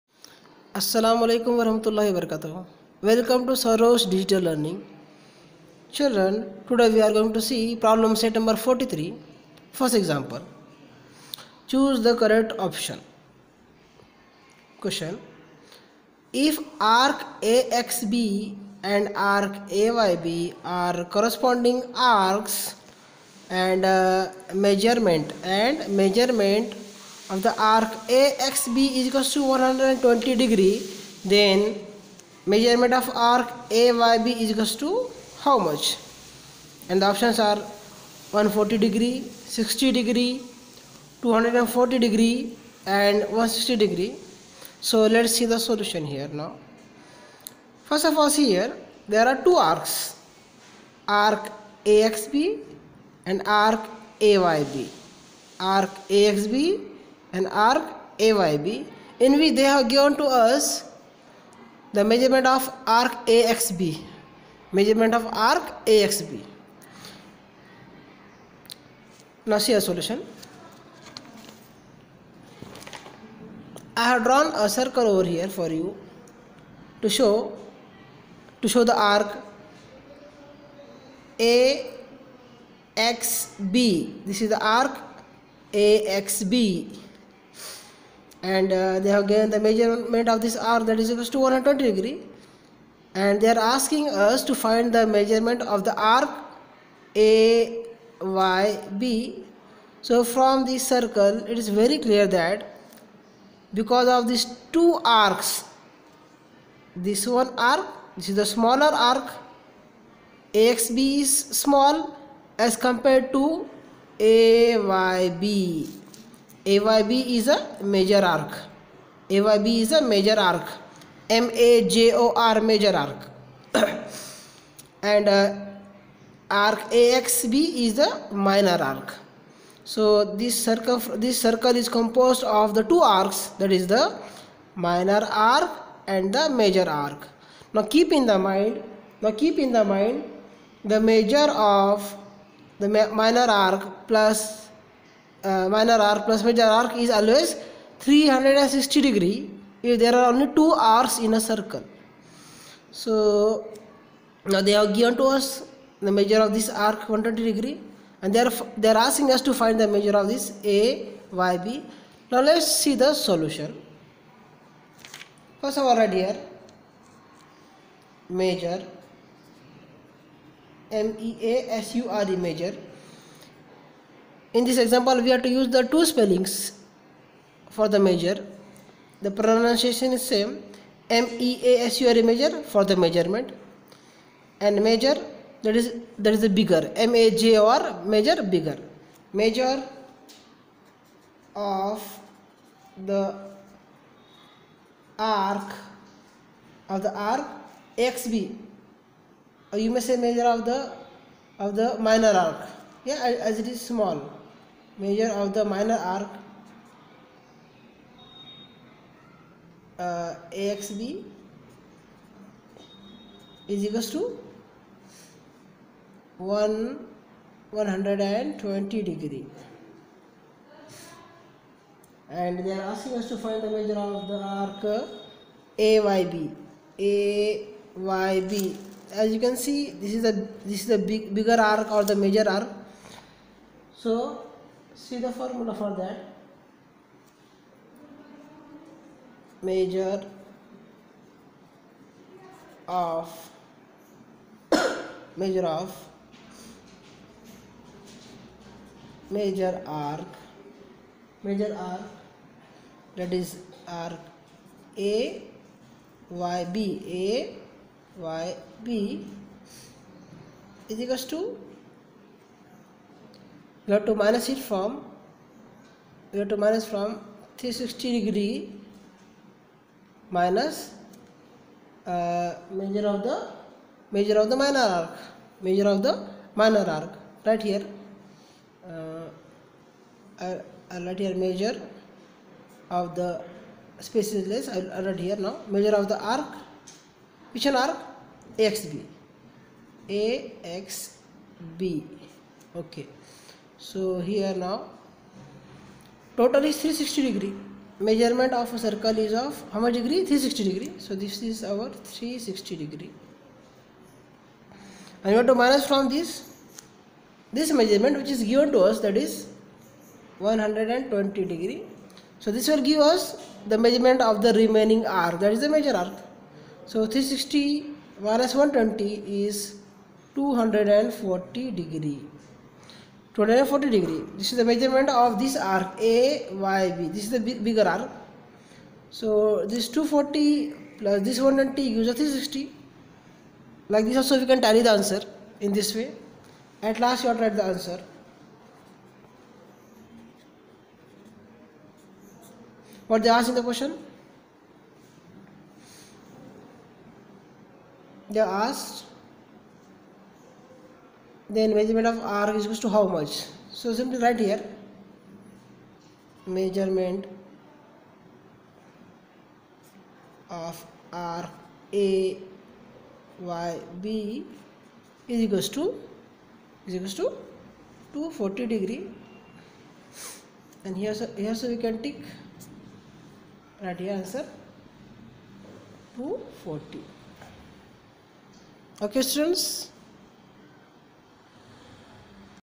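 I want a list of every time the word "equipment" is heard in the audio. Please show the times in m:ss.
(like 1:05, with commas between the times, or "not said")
not said.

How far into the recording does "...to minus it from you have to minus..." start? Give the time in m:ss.
4:24.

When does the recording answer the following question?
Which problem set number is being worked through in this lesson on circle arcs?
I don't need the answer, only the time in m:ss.
0:08.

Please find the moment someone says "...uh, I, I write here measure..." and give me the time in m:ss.
4:38.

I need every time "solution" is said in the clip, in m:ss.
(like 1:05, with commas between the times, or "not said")
0:45, 1:09, 2:43.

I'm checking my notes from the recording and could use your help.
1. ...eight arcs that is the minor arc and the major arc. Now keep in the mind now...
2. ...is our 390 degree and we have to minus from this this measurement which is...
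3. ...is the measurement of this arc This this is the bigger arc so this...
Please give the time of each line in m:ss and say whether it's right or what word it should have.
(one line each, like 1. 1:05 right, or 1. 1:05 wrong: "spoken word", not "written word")
1. 2:12 wrong: "two", not "eight"
2. 5:01 wrong: "360", not "390"
3. 5:24 wrong: "AYB", not "This".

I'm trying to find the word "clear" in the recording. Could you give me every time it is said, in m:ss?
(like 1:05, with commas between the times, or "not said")
1:41.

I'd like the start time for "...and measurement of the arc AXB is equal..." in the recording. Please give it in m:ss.
0:25.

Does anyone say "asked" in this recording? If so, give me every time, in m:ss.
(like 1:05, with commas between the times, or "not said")
5:43, 5:48.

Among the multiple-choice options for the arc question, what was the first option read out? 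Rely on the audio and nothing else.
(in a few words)
140 degrees.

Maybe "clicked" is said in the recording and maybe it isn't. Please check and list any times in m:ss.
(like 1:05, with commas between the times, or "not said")
not said.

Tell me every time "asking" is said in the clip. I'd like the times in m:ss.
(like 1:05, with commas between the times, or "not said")
1:33, 2:38, 3:42.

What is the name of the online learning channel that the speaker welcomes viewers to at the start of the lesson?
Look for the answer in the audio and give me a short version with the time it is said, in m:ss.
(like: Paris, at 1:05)
Sarosh Digital Learning, at 0:03.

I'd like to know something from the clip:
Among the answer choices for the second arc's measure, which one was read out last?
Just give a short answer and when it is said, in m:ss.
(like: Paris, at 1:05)
160 degrees, at 0:43.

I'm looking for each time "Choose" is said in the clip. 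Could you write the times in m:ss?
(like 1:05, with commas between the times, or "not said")
0:11.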